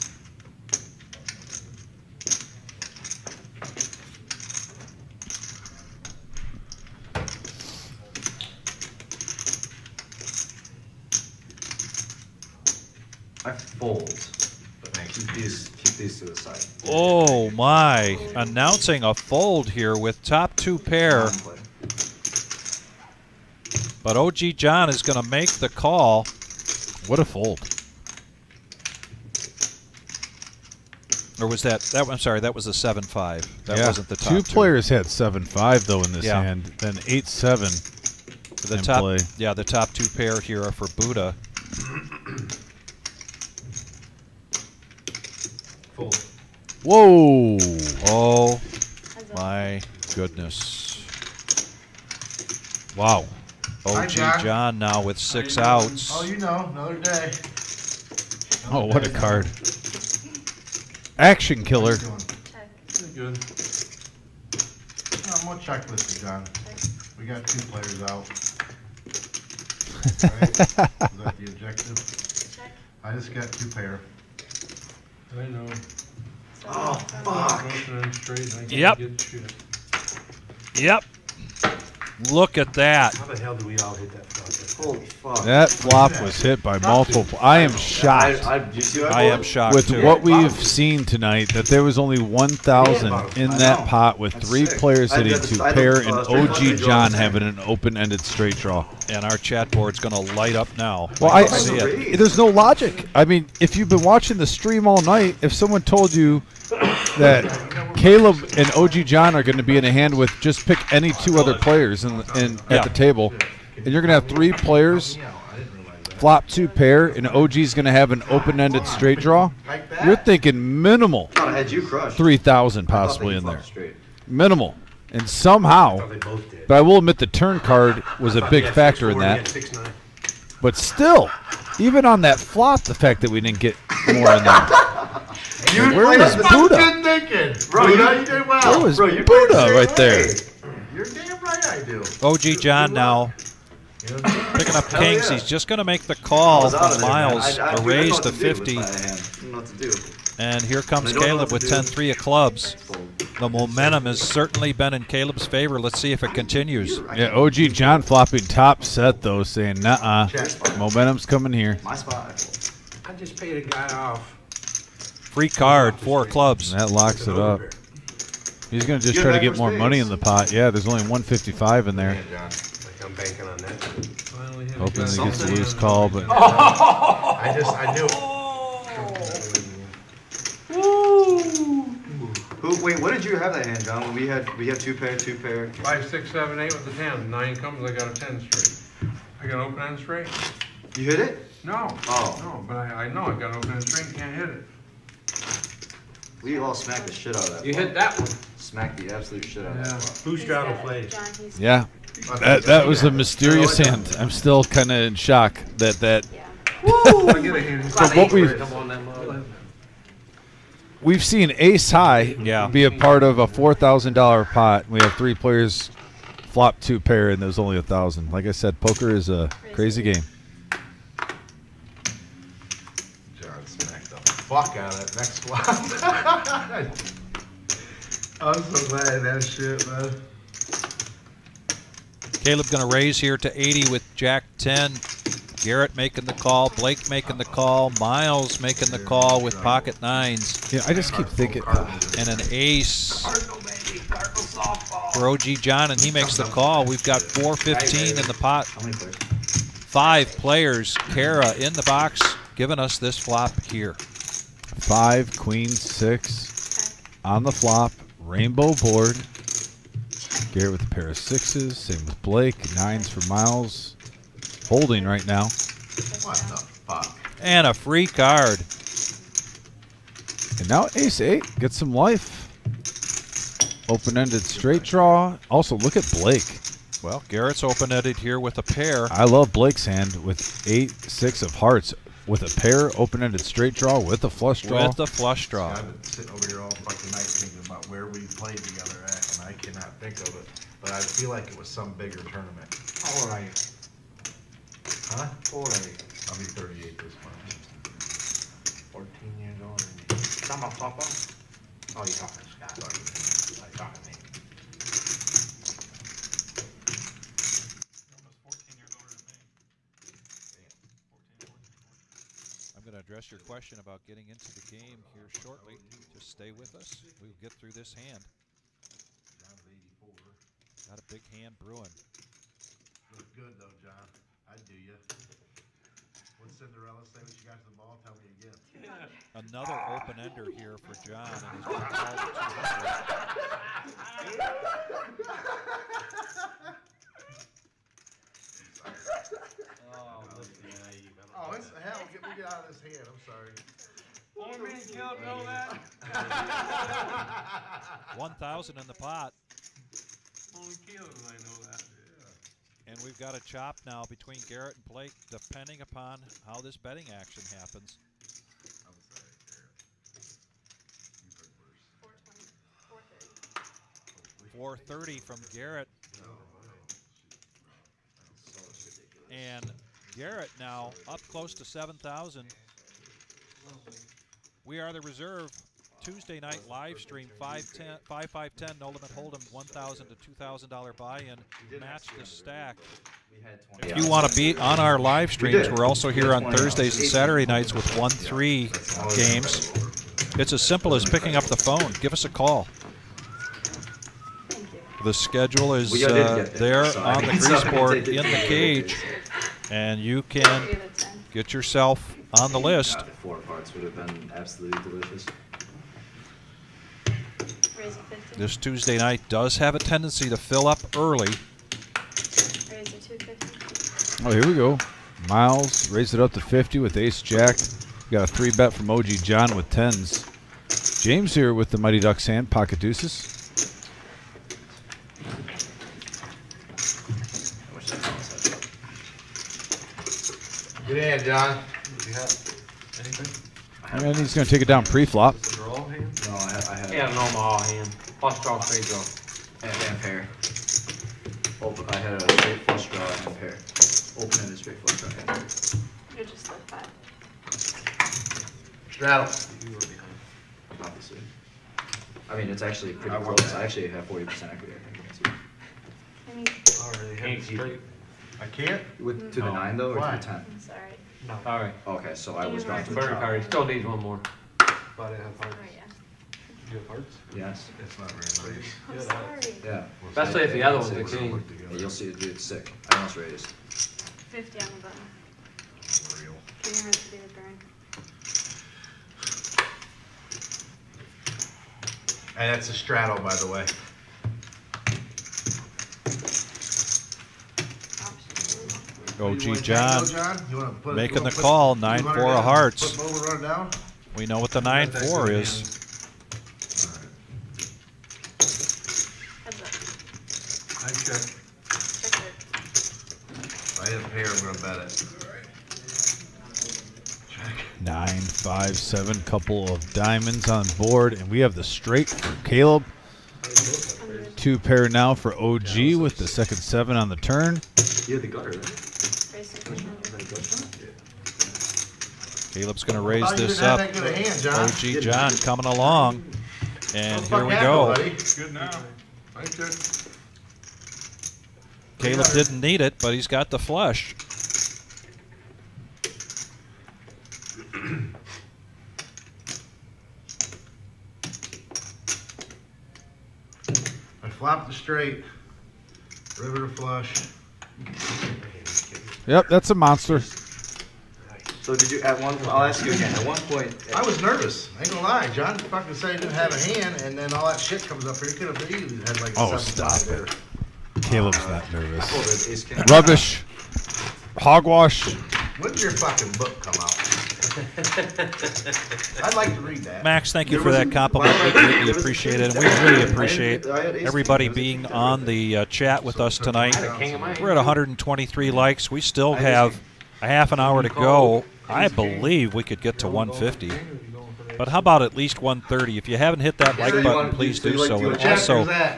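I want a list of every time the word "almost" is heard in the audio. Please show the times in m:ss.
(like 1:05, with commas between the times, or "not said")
5:08, 7:52.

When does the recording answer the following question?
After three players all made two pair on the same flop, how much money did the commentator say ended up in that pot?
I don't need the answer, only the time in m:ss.
1:31.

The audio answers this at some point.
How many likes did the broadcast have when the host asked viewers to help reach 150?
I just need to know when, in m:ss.
9:37.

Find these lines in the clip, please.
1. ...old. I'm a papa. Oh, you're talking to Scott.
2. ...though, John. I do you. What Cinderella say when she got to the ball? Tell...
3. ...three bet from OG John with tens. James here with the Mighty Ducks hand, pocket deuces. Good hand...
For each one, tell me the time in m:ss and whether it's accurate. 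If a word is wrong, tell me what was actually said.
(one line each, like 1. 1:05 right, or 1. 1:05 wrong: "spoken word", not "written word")
1. 4:59 right
2. 5:23 right
3. 6:58 right.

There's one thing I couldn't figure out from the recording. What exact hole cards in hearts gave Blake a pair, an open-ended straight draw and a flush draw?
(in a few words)
Eight, six.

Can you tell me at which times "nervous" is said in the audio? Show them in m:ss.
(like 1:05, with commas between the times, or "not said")
9:14, 9:21.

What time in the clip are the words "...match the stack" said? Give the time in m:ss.
6:21.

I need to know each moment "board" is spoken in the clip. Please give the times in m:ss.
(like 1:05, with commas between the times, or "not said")
1:39, 4:18, 6:37, 8:30.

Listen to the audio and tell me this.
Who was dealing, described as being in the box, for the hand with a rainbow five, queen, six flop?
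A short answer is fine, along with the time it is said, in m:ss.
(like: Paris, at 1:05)
Kara, at 4:10.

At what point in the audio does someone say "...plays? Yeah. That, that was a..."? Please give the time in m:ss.
3:20.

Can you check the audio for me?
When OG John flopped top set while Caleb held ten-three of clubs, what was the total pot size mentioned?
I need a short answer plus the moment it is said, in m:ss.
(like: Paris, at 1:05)
155, at 2:51.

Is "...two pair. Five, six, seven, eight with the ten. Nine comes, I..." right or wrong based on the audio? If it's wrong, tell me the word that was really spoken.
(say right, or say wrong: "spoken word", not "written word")
right.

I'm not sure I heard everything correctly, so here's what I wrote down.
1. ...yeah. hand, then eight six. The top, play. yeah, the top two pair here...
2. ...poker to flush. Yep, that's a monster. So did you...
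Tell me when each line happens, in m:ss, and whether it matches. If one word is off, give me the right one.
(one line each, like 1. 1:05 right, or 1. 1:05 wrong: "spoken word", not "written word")
1. 0:36 wrong: "seven", not "six"
2. 9:06 wrong: "river", not "poker".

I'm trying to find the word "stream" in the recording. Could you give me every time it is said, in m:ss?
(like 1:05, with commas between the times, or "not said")
1:44, 6:16, 6:25.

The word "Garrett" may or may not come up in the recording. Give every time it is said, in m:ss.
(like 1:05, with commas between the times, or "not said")
3:55, 4:20, 4:37, 5:54, 5:59, 6:05, 6:10.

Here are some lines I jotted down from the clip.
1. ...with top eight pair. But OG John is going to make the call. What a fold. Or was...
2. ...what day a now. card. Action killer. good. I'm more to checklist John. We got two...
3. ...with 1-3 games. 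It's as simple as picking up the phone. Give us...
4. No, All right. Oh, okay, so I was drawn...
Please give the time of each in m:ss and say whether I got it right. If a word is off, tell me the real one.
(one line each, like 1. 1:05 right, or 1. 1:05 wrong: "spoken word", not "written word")
1. 0:19 wrong: "two", not "eight"
2. 0:58 right
3. 6:27 right
4. 7:41 right.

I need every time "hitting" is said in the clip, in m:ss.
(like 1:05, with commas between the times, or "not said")
1:35.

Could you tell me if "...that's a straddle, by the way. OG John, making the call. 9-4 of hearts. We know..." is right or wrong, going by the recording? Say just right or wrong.
right.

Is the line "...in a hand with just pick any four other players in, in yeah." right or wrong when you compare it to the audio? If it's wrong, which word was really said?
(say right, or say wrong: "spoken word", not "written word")
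wrong: "two", not "four".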